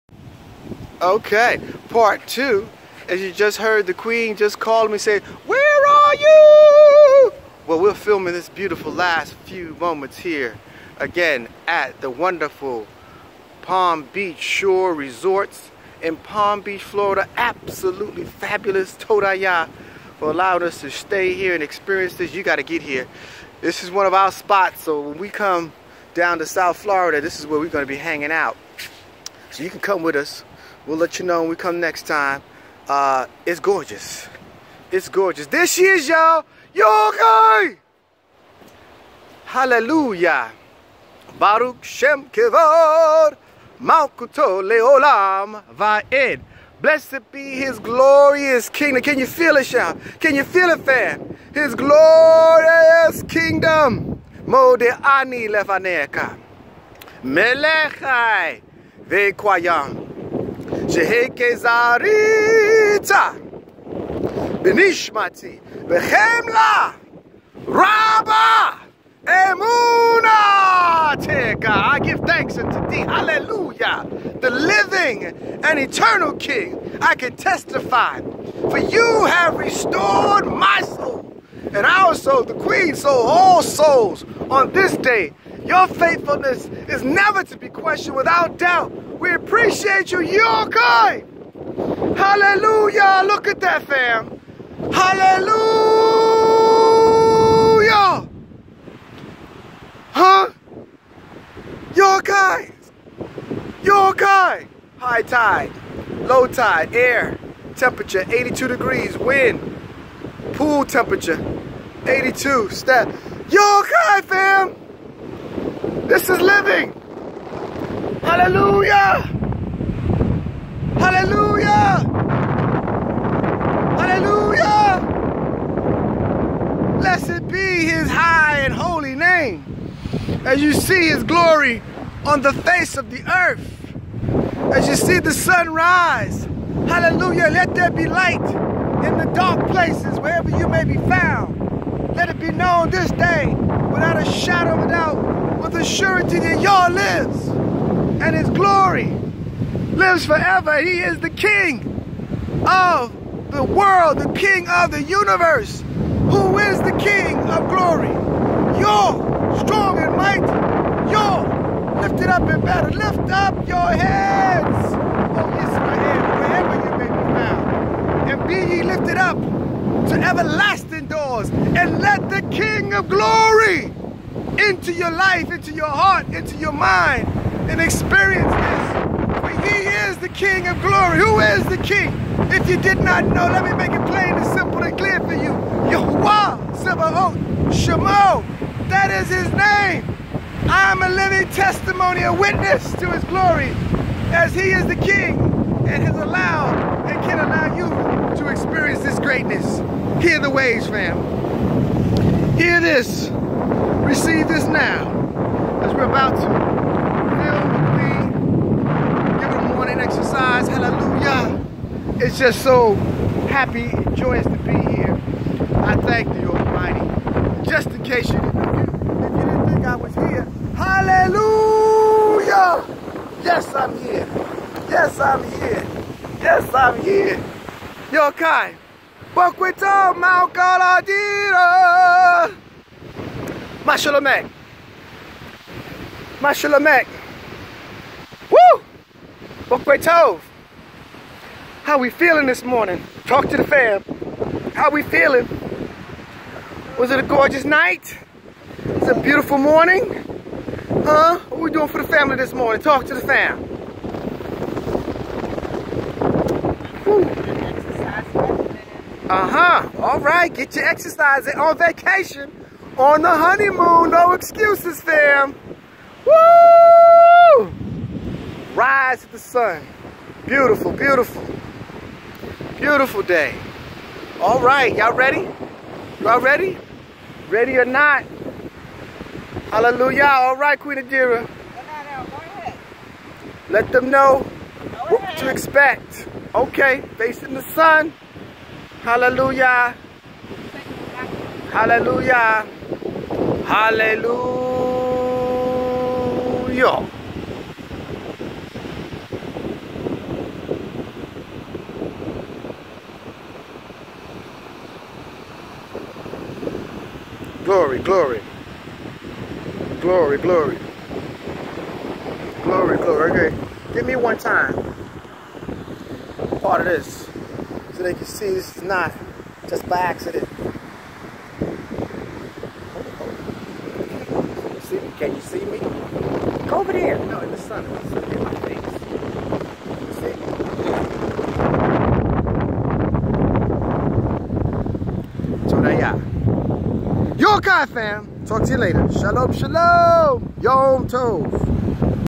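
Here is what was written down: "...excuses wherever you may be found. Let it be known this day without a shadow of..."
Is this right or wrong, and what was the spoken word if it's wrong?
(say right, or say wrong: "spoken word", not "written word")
wrong: "places", not "excuses".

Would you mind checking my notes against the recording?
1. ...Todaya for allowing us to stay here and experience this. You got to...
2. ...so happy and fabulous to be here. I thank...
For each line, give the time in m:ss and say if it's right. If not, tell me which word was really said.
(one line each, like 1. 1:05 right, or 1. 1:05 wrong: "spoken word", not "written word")
1. 0:18 right
2. 3:32 wrong: "joyous", not "fabulous".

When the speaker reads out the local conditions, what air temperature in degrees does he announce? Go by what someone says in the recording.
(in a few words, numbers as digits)
82 degrees.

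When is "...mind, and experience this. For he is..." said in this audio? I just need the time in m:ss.
2:56.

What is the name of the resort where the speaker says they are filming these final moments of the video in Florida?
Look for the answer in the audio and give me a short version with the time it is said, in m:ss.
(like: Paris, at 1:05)
Palm Beach Shore Resorts, at 0:13.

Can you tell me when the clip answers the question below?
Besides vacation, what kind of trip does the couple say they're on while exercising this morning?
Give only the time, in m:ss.
4:23.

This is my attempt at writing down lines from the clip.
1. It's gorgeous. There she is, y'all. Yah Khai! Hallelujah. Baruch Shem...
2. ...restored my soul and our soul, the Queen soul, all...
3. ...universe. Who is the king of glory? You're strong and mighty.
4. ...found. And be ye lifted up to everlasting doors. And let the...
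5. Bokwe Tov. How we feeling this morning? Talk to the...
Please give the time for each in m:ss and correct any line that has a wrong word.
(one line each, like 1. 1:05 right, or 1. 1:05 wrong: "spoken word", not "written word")
1. 0:34 right
2. 1:19 right
3. 2:35 right
4. 2:47 right
5. 3:59 right.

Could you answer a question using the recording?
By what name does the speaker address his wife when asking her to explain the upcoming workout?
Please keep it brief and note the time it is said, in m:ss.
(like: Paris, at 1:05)
Queen Adira, at 4:40.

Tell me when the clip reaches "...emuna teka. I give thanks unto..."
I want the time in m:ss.
1:09.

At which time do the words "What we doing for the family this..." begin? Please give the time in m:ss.
4:11.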